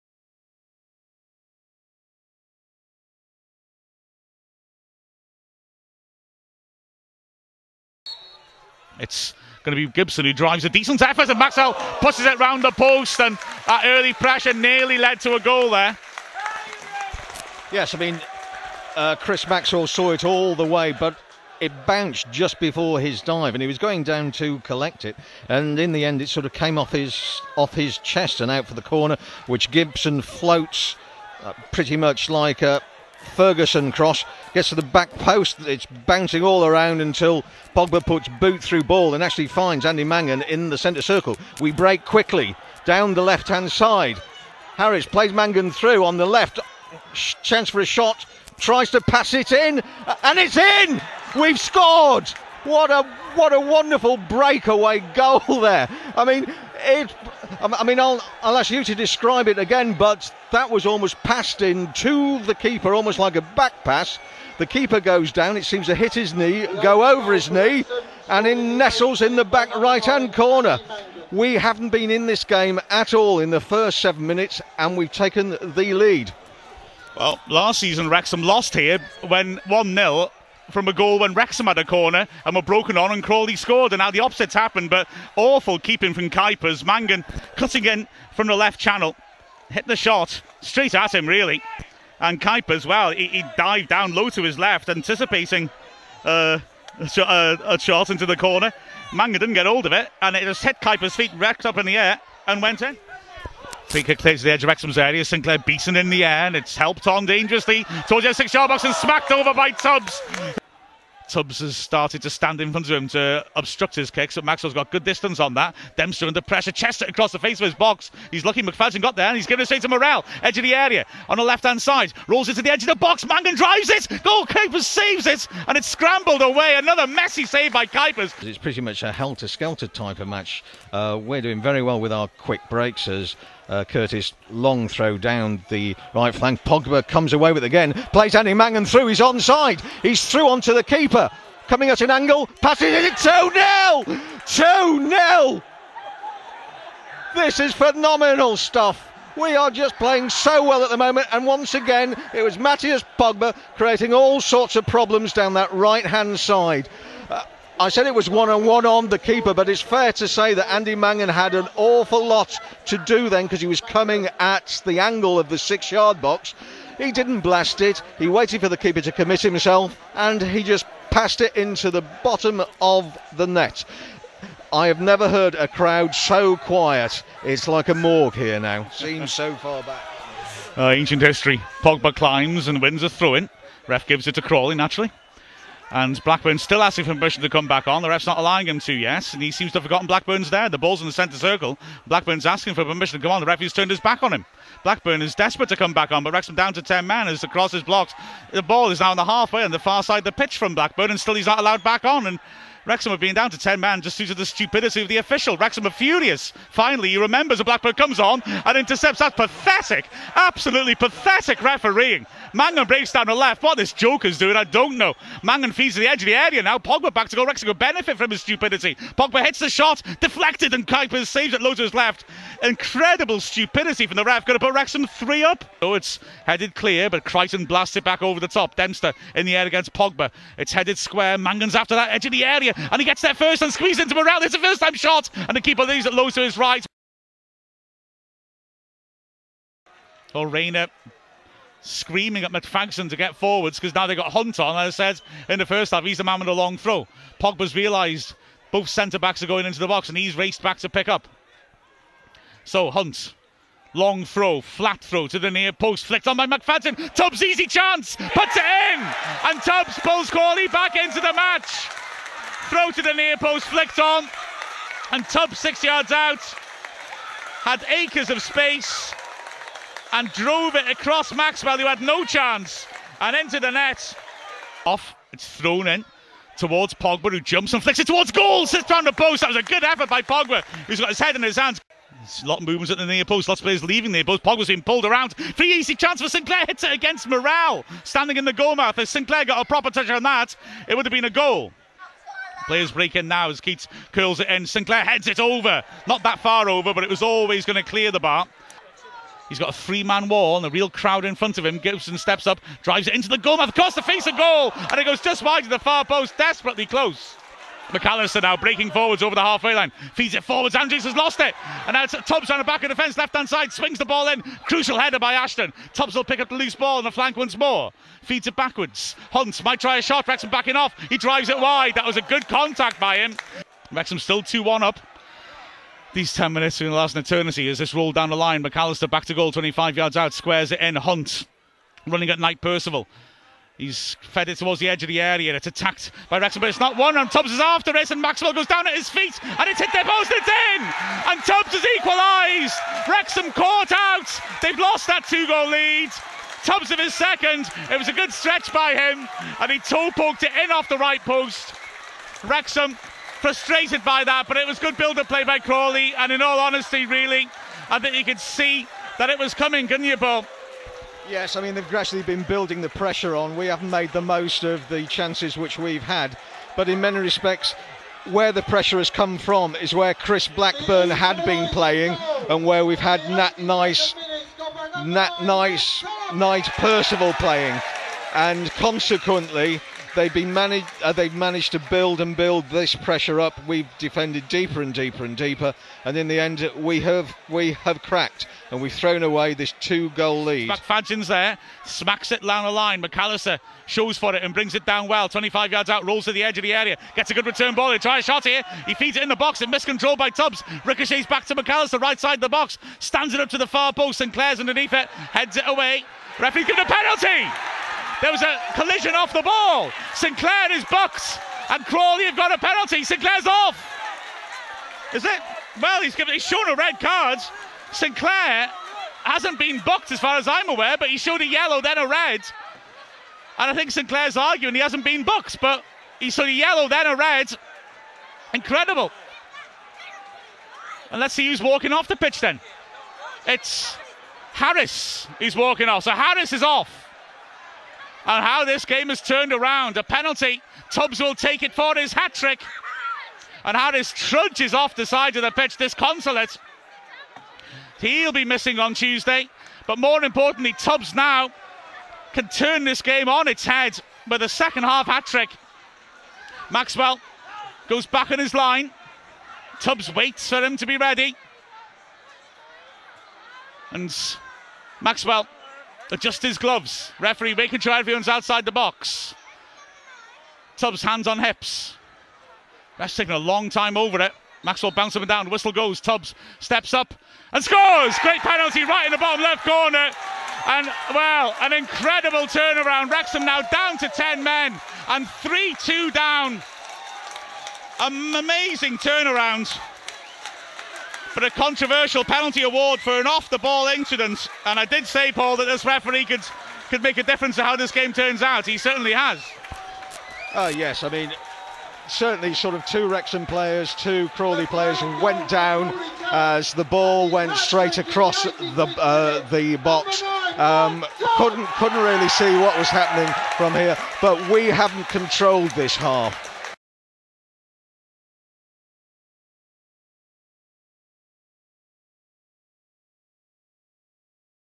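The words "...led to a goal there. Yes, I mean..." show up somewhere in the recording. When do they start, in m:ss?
0:14.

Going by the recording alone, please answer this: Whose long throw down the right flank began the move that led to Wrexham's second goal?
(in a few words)
Curtis.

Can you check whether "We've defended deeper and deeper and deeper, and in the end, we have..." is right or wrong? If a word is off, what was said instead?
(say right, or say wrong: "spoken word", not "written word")
right.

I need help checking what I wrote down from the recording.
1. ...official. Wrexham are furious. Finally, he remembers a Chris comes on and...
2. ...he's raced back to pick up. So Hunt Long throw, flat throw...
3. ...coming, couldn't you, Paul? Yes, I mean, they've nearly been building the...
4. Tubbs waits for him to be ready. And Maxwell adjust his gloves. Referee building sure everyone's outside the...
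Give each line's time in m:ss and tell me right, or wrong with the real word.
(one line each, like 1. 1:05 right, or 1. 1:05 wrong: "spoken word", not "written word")
1. 3:25 wrong: "Blackburn", not "Chris"
2. 4:10 right
3. 5:59 wrong: "gradually", not "nearly"
4. 7:39 wrong: "making", not "building".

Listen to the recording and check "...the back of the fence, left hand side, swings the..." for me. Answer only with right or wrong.
right.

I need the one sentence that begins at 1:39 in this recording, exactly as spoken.
Mangan didn't get hold of it, and it just hit Kuipers' feet, racked up in the air, and went in.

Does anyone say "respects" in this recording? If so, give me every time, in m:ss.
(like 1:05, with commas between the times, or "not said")
6:07.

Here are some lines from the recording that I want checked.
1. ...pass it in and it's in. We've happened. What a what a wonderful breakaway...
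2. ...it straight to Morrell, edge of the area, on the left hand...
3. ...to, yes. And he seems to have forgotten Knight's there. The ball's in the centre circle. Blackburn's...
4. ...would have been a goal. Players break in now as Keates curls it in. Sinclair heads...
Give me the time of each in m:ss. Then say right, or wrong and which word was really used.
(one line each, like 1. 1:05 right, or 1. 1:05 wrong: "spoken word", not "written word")
1. 0:49 wrong: "scored", not "happened"
2. 1:59 right
3. 3:08 wrong: "Blackburn", not "Knight"
4. 4:50 right.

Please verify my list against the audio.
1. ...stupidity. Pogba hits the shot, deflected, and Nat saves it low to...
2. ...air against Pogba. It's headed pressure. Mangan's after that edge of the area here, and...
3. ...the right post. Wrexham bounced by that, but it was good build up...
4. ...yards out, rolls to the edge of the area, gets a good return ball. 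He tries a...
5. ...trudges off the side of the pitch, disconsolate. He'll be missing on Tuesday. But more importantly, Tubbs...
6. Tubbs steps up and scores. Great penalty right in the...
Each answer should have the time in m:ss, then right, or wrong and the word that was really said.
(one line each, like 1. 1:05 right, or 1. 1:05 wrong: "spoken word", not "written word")
1. 3:38 wrong: "Kuipers", not "Nat"
2. 3:49 wrong: "square", not "pressure"
3. 5:50 wrong: "frustrated", not "bounced"
4. 6:35 right
5. 7:24 right
6. 7:55 right.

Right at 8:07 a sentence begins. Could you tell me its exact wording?
An amazing turnaround for a controversial penalty award for an off the ball incident.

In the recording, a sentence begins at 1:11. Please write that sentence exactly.
We haven't been in this game at all in the first seven minutes, and we've taken the lead.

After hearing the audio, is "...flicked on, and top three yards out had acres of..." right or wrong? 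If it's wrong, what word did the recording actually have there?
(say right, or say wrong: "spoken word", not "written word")
wrong: "six", not "three".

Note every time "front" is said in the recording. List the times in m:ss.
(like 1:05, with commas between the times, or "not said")
1:52, 5:01.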